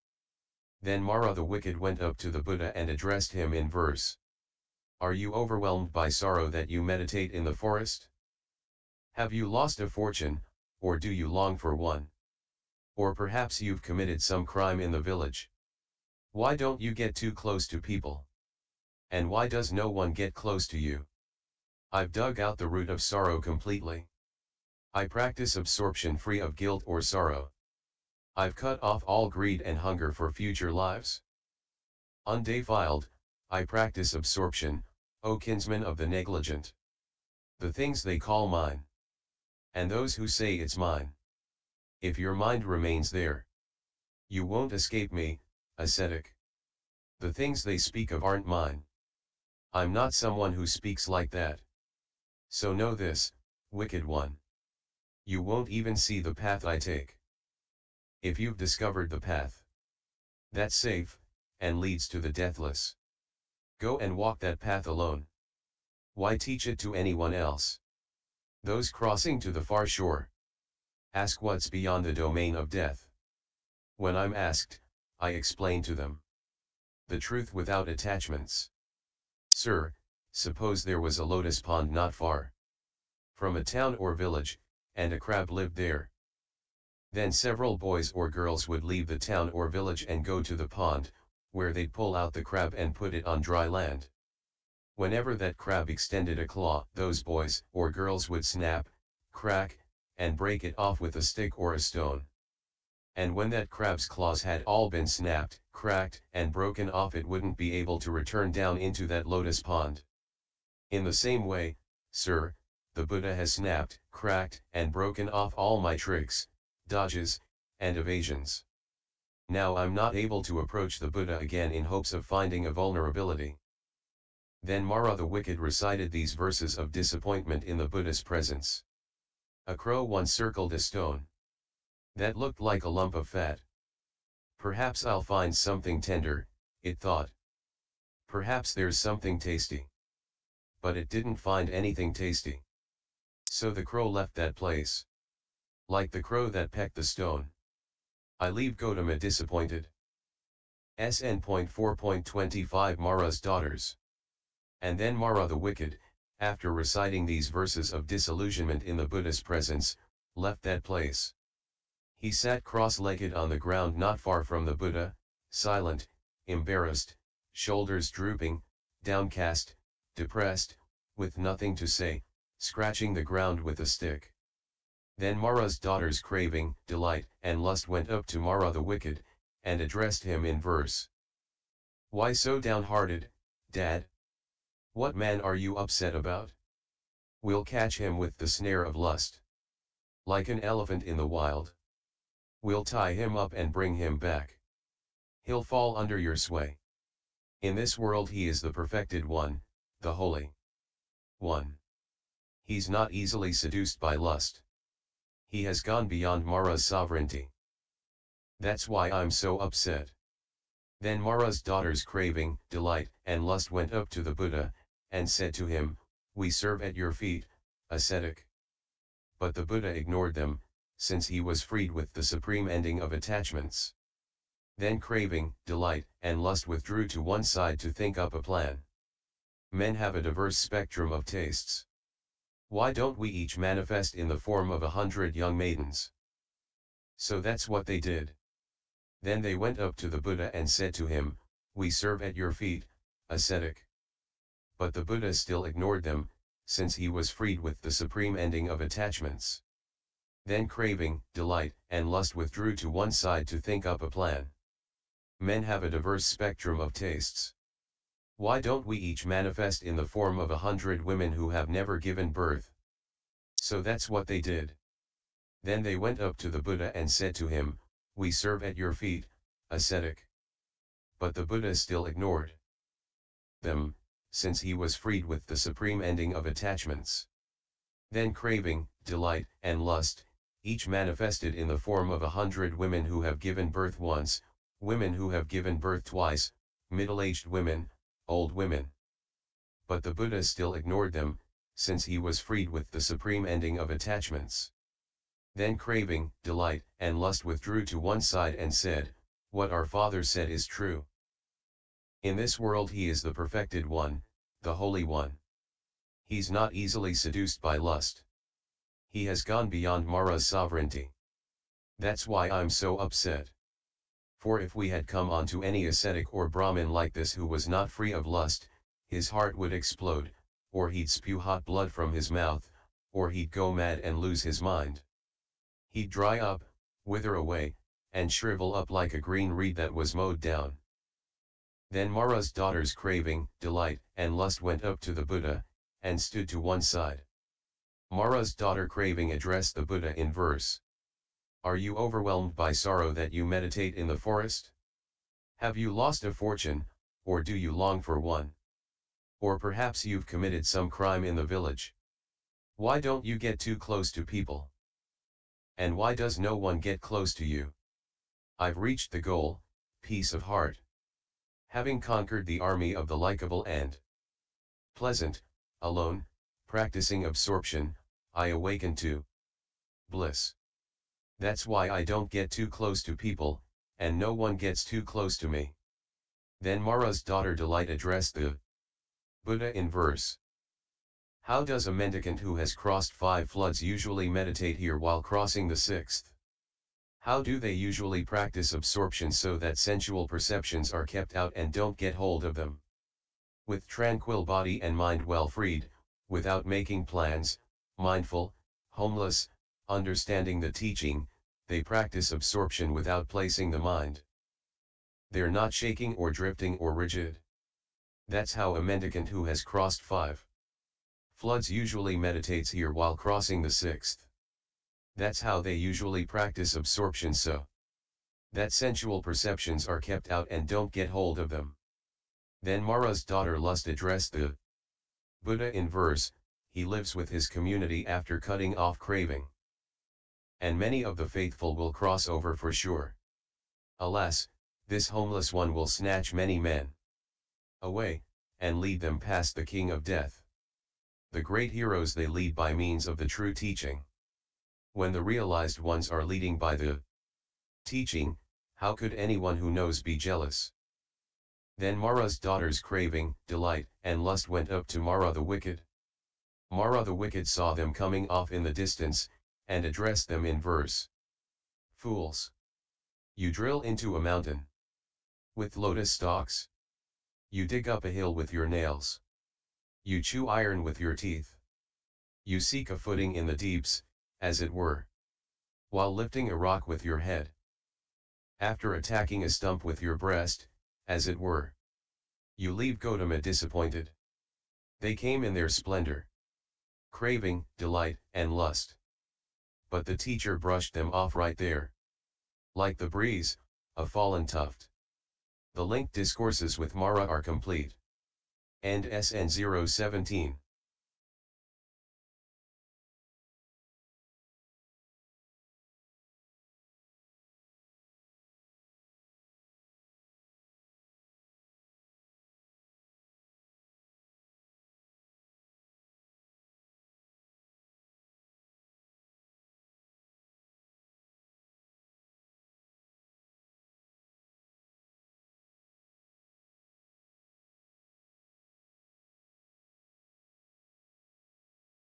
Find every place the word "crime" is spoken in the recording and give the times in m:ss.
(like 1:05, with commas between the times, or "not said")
0:14, 5:50.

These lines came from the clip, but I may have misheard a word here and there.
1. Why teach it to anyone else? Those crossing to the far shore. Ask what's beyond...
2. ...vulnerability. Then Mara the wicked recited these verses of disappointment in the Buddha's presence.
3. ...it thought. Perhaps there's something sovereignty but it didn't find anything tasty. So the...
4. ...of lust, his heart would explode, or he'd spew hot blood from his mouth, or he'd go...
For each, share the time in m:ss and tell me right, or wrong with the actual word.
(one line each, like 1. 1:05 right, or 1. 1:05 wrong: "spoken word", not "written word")
1. 1:06 right
2. 2:02 right
3. 2:16 wrong: "tasty", not "sovereignty"
4. 5:18 right.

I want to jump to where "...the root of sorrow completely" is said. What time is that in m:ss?
0:22.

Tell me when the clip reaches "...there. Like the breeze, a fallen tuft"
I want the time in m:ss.
8:11.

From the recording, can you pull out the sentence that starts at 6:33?
With tranquil body and mind well freed, without making plans, mindful, homeless, understanding the teaching, they practice absorption without placing the mind.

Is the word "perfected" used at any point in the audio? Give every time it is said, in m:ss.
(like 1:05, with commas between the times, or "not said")
3:18, 5:03.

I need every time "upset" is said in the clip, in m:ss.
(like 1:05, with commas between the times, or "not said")
3:05, 3:29, 5:12.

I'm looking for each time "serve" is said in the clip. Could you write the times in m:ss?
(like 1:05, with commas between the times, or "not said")
3:36, 4:01, 4:28.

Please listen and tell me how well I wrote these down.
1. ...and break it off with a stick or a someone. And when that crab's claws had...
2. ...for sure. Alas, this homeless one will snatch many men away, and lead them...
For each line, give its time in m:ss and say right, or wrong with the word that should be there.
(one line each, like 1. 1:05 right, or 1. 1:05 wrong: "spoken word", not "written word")
1. 1:40 wrong: "stone", not "someone"
2. 7:12 right.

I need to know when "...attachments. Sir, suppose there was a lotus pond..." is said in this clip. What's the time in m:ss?
1:17.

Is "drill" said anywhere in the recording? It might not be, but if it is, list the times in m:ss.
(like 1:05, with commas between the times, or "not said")
7:43.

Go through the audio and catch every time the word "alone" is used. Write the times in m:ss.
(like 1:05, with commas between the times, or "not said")
1:04, 6:05.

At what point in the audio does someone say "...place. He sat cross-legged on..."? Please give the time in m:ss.
2:40.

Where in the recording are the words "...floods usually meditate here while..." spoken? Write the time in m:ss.
6:23.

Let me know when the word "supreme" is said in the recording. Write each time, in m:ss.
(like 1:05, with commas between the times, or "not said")
3:42, 4:07, 4:35, 4:53.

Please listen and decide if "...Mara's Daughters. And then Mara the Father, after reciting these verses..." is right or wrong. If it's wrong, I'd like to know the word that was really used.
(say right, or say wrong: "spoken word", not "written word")
wrong: "Wicked", not "Father".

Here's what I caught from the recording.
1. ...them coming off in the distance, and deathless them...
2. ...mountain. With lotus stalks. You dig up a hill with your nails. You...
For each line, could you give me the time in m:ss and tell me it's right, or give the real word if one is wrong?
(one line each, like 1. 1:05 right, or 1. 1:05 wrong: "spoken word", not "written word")
1. 7:37 wrong: "address", not "deathless"
2. 7:44 right.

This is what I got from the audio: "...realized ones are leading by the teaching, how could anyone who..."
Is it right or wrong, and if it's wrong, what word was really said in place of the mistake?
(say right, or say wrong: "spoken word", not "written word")
right.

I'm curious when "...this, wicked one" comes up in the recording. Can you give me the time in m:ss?
0:52.